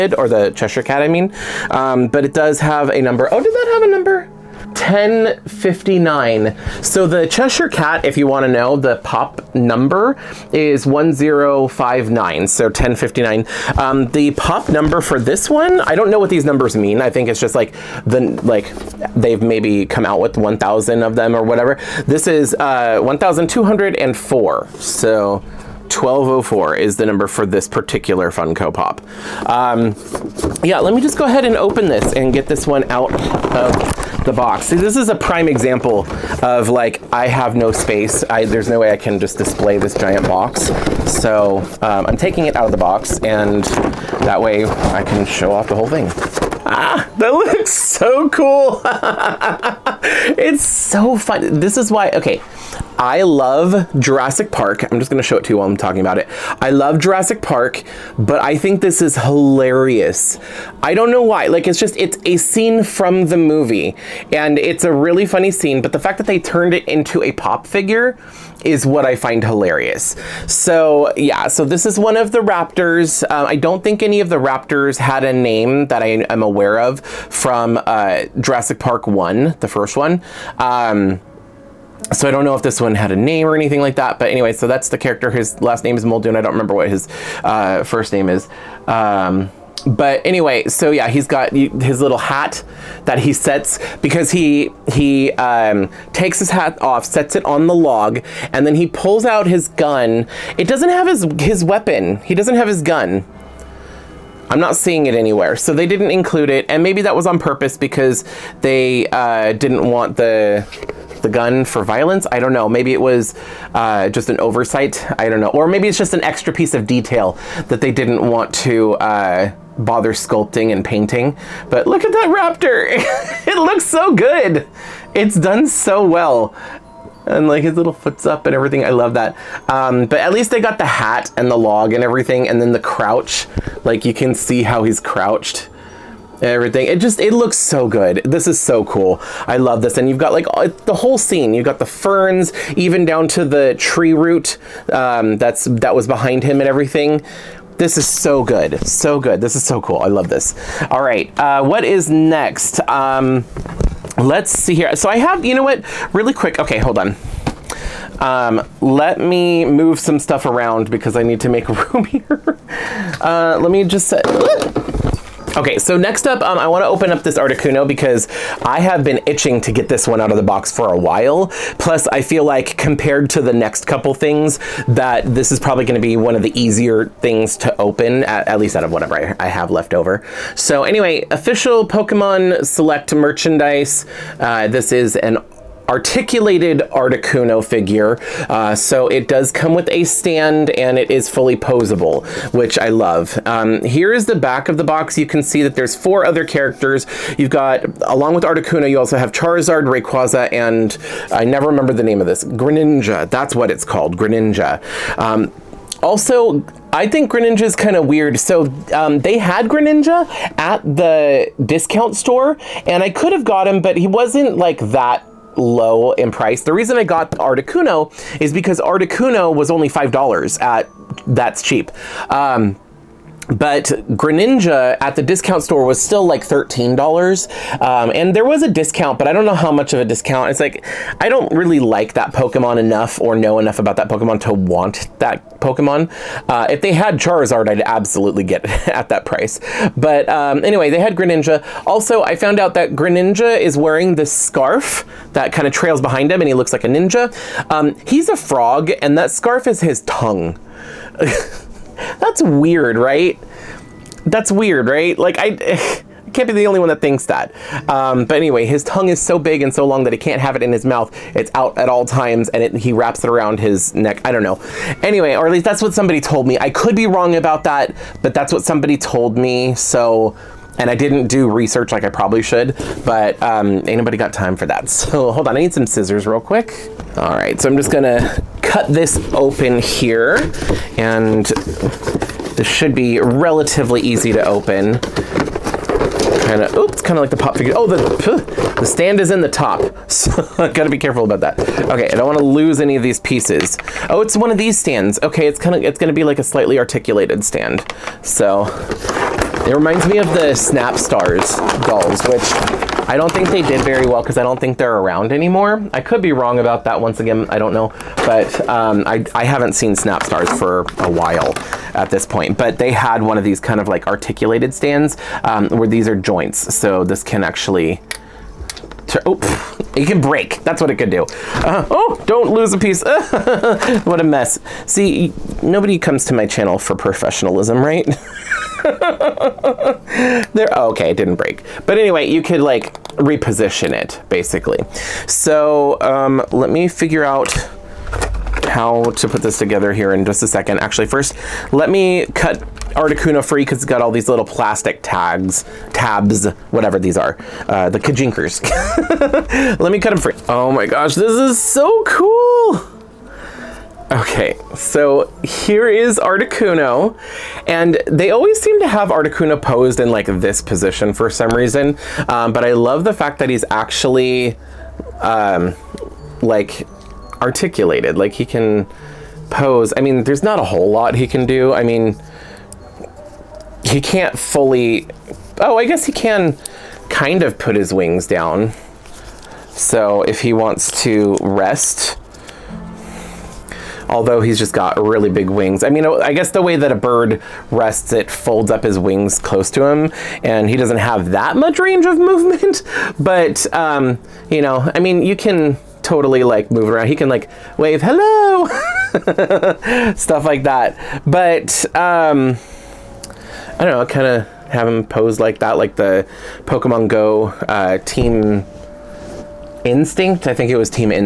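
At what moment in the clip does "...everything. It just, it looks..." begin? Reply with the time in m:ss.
2:16.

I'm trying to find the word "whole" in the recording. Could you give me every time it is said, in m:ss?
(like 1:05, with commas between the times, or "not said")
0:45, 2:20, 6:10.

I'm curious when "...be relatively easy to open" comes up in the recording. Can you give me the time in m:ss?
4:42.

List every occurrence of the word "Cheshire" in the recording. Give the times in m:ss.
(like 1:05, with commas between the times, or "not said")
0:00, 0:07.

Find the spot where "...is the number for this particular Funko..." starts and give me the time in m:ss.
0:26.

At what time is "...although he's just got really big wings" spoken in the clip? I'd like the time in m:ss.
6:24.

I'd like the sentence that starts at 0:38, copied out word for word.
I, there's no way I can just display this giant box.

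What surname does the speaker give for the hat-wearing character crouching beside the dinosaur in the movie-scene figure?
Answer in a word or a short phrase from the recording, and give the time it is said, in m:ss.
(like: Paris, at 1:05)
Muldoon, at 1:26.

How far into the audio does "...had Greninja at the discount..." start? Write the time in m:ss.
3:29.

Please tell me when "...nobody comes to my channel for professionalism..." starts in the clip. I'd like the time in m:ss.
5:25.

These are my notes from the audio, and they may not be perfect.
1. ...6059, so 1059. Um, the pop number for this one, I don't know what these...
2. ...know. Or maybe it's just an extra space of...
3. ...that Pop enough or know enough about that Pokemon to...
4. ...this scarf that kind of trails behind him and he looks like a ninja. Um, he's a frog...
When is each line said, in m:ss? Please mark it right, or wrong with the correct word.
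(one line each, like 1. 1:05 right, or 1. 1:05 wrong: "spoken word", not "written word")
1. 0:10 wrong: "1059", not "6059"
2. 1:55 wrong: "piece", not "space"
3. 3:52 wrong: "Pokemon", not "Pop"
4. 4:04 right.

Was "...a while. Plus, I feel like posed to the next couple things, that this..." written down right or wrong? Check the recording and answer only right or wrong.
wrong.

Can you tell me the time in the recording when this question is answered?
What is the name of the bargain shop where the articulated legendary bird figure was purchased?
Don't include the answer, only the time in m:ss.
3:41.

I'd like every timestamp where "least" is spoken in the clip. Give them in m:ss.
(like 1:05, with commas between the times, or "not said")
2:10, 2:58, 4:25.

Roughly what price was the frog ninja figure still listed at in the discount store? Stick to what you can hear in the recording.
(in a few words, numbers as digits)
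$13.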